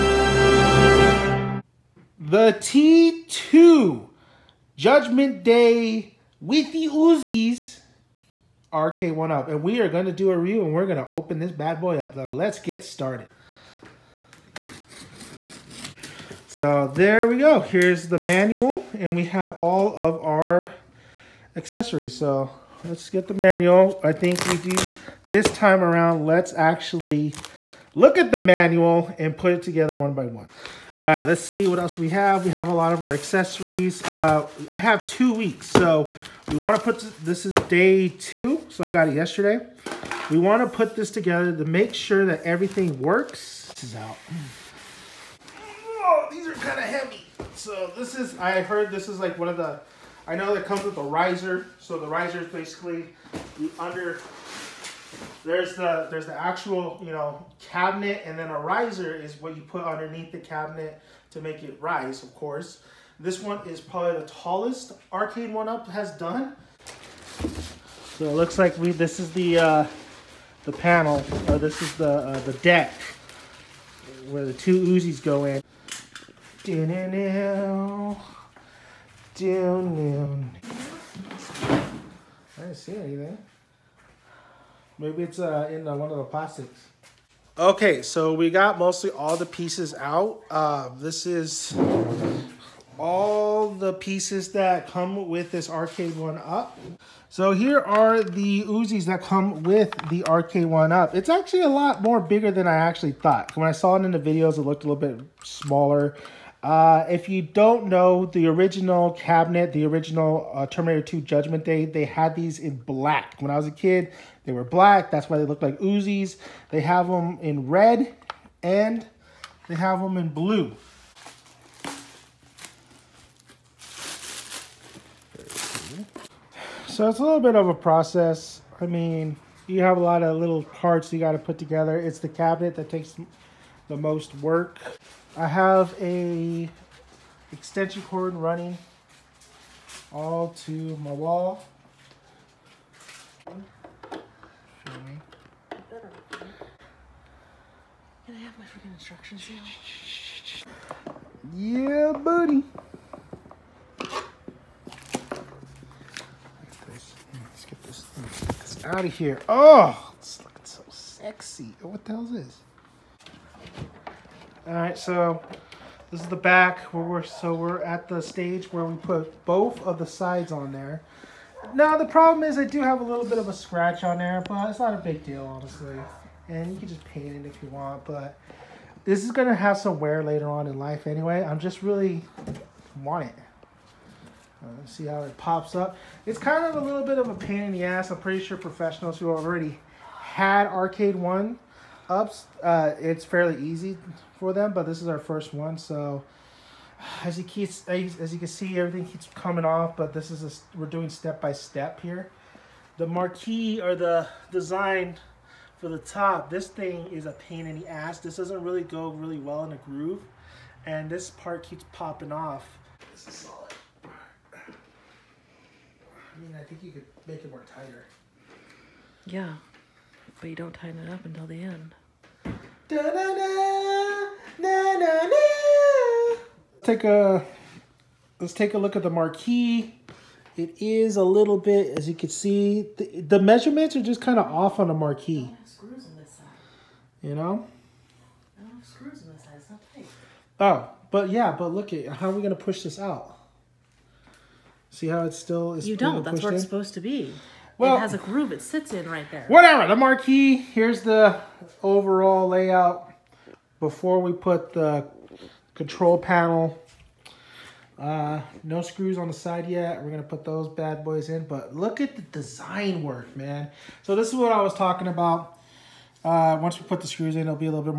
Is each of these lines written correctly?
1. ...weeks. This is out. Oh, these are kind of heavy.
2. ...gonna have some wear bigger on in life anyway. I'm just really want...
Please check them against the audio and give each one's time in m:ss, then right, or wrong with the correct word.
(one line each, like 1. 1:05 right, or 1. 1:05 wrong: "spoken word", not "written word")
1. 0:42 wrong: "works", not "weeks"
2. 2:59 wrong: "later", not "bigger".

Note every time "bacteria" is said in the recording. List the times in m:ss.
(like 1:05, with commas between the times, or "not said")
not said.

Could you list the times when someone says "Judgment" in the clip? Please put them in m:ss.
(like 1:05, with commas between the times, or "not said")
0:05, 1:51.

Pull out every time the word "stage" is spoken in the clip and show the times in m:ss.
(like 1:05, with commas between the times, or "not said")
2:48.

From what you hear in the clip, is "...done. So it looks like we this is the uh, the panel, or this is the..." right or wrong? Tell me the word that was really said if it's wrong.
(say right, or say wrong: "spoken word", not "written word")
right.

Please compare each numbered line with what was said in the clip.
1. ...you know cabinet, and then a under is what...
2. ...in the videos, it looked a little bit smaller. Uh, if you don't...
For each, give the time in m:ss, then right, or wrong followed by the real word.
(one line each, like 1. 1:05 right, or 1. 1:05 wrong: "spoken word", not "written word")
1. 0:57 wrong: "riser", not "under"
2. 1:44 right.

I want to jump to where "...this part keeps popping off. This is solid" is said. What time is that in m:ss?
3:31.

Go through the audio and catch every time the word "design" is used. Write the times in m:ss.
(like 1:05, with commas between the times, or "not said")
3:24, 4:22.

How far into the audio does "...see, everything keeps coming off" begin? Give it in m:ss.
3:18.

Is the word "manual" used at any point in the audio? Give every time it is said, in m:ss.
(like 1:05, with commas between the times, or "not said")
0:18, 0:23, 0:28.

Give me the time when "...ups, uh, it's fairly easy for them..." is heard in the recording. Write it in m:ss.
3:12.